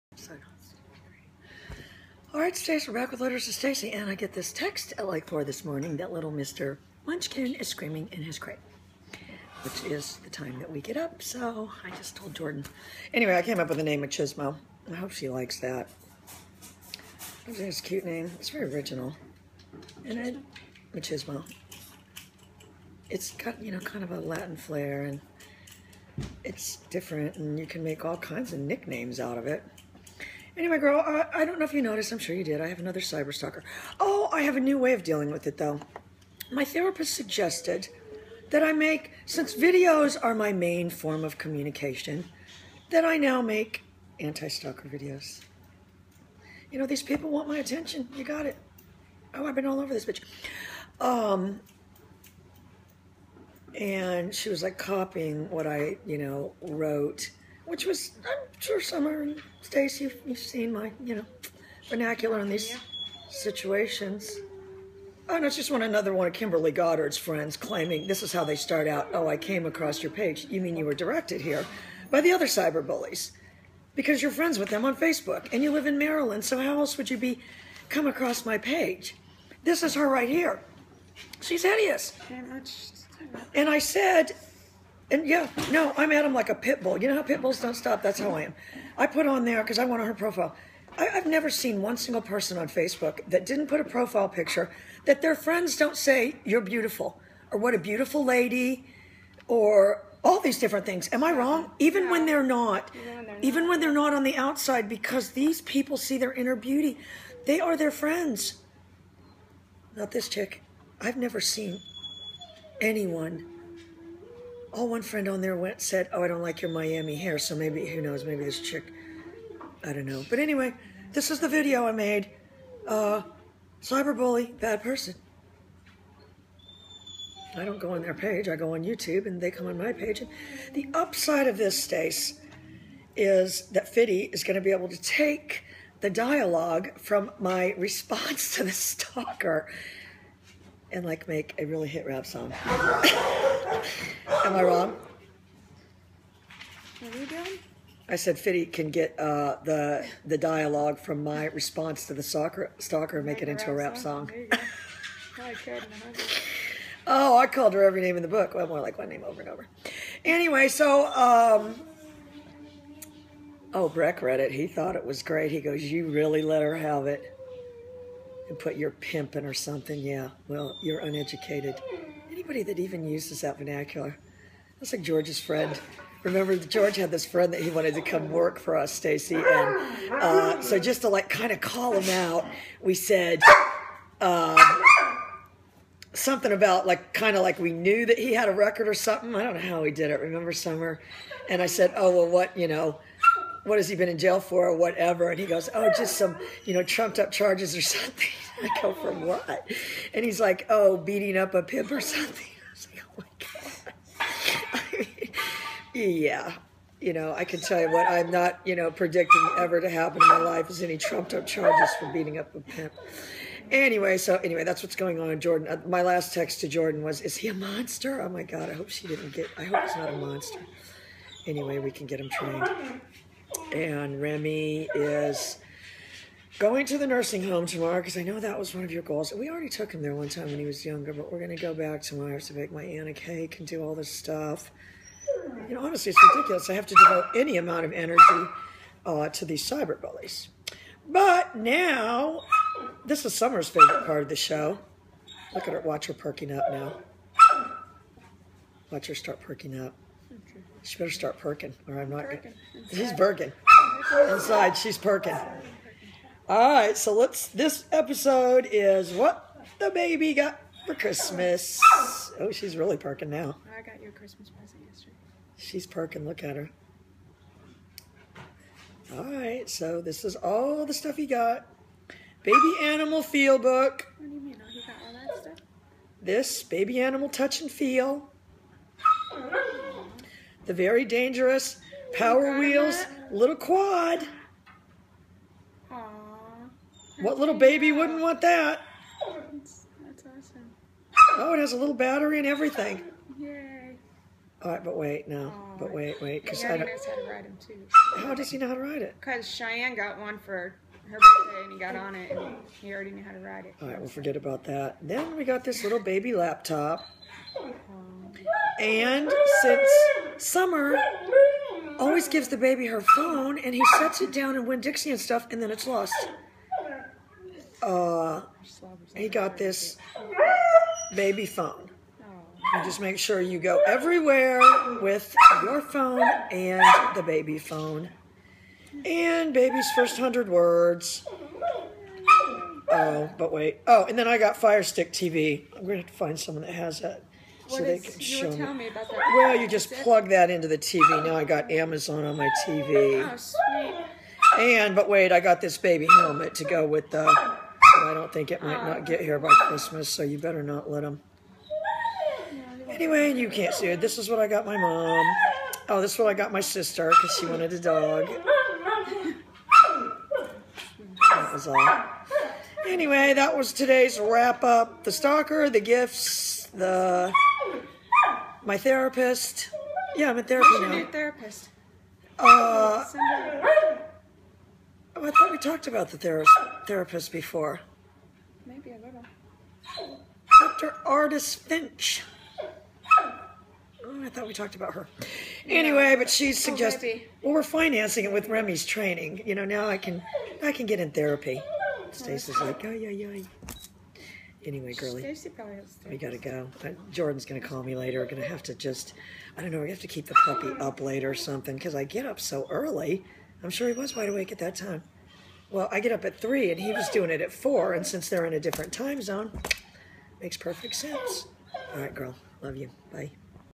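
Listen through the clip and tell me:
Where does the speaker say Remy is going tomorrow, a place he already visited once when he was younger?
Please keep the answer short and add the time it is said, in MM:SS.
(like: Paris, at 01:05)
The nursing home, at 03:46.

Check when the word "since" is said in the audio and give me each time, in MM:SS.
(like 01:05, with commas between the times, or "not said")
00:39, 05:09, 06:48.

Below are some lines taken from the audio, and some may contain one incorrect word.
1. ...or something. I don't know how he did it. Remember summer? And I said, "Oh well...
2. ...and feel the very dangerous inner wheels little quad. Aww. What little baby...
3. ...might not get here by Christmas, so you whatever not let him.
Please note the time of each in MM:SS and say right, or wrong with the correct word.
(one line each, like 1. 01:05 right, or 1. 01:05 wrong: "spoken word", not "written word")
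1. 03:08 right
2. 04:37 wrong: "power", not "inner"
3. 05:48 wrong: "better", not "whatever".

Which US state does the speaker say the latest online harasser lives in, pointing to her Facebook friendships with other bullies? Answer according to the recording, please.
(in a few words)
Maryland.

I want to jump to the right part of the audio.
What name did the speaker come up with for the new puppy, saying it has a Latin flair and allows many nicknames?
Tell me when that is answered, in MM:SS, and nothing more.
00:14.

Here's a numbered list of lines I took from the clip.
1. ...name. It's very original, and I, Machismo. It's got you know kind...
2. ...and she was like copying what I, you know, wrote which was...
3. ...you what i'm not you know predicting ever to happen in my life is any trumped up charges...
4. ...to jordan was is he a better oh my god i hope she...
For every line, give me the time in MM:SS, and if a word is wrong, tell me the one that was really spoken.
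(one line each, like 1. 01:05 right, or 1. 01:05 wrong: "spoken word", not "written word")
1. 00:18 right
2. 00:53 right
3. 03:27 right
4. 03:36 wrong: "monster", not "better".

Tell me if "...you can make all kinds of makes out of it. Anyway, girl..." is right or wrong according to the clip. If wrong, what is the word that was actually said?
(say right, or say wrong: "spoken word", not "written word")
wrong: "nicknames", not "makes".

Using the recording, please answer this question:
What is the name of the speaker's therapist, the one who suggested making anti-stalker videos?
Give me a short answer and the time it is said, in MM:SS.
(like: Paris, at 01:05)
Dr. Artis Finch, at 06:20.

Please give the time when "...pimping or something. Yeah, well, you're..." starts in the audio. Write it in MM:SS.
02:48.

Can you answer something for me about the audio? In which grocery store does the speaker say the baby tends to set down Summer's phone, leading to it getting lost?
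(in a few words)
Winn-Dixie.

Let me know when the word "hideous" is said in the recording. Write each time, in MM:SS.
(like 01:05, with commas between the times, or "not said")
01:21.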